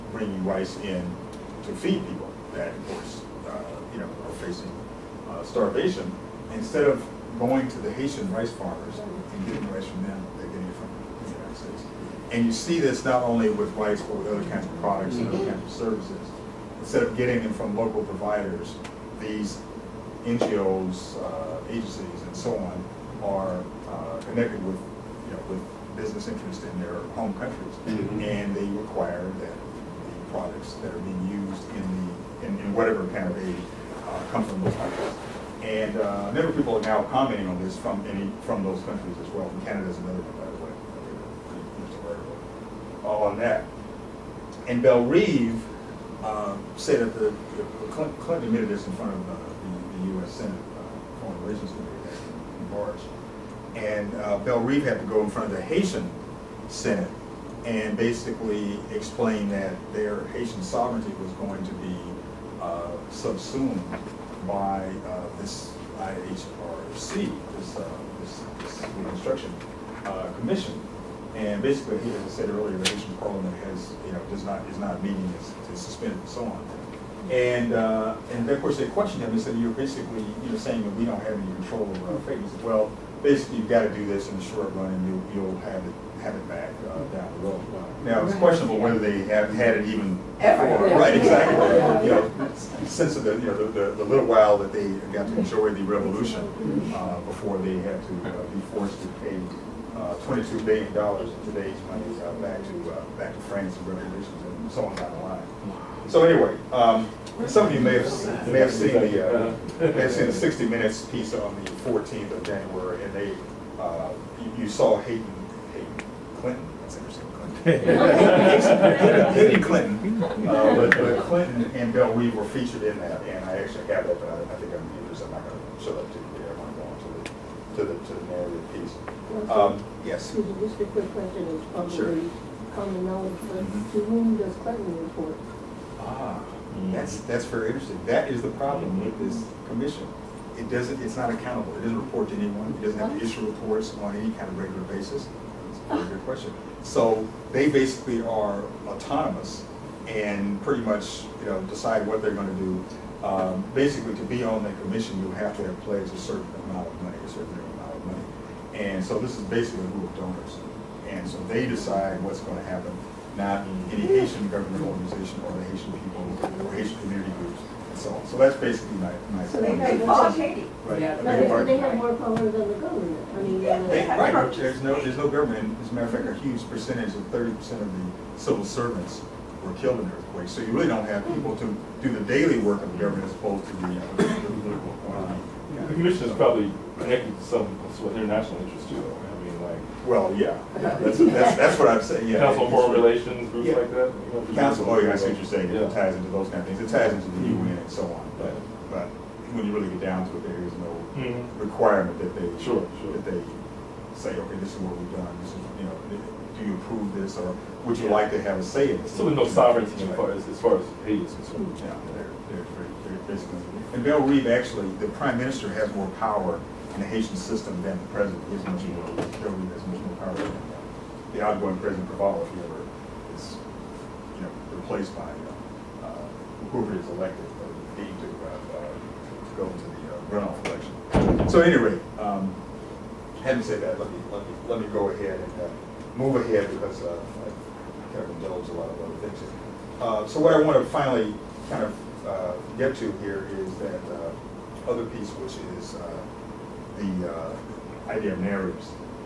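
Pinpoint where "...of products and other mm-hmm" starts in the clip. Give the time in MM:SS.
00:14.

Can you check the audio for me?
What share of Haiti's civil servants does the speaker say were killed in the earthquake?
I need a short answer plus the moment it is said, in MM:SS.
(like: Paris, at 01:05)
30%, at 02:57.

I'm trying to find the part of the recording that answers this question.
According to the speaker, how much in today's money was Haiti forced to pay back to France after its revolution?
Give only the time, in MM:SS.
01:40.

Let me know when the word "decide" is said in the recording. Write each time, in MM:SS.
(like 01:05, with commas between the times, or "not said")
02:31, 02:41.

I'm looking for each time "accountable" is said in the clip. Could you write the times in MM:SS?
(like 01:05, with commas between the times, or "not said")
02:21.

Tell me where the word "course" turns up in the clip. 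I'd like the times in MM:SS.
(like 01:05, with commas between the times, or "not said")
00:02, 01:18.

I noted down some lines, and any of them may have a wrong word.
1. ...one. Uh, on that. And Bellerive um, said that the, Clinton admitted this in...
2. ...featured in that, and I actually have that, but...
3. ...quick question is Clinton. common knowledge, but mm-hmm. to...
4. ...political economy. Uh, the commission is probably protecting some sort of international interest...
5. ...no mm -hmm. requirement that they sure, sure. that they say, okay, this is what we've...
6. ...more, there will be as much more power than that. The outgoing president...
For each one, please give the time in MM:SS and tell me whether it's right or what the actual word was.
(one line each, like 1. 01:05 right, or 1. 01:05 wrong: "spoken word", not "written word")
1. 00:40 right
2. 02:02 right
3. 02:10 wrong: "Sure", not "Clinton"
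4. 03:04 right
5. 03:20 right
6. 03:38 right.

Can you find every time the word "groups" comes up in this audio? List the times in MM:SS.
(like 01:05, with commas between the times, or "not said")
02:39, 02:47, 03:13.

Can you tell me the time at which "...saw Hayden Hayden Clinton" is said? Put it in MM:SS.
01:54.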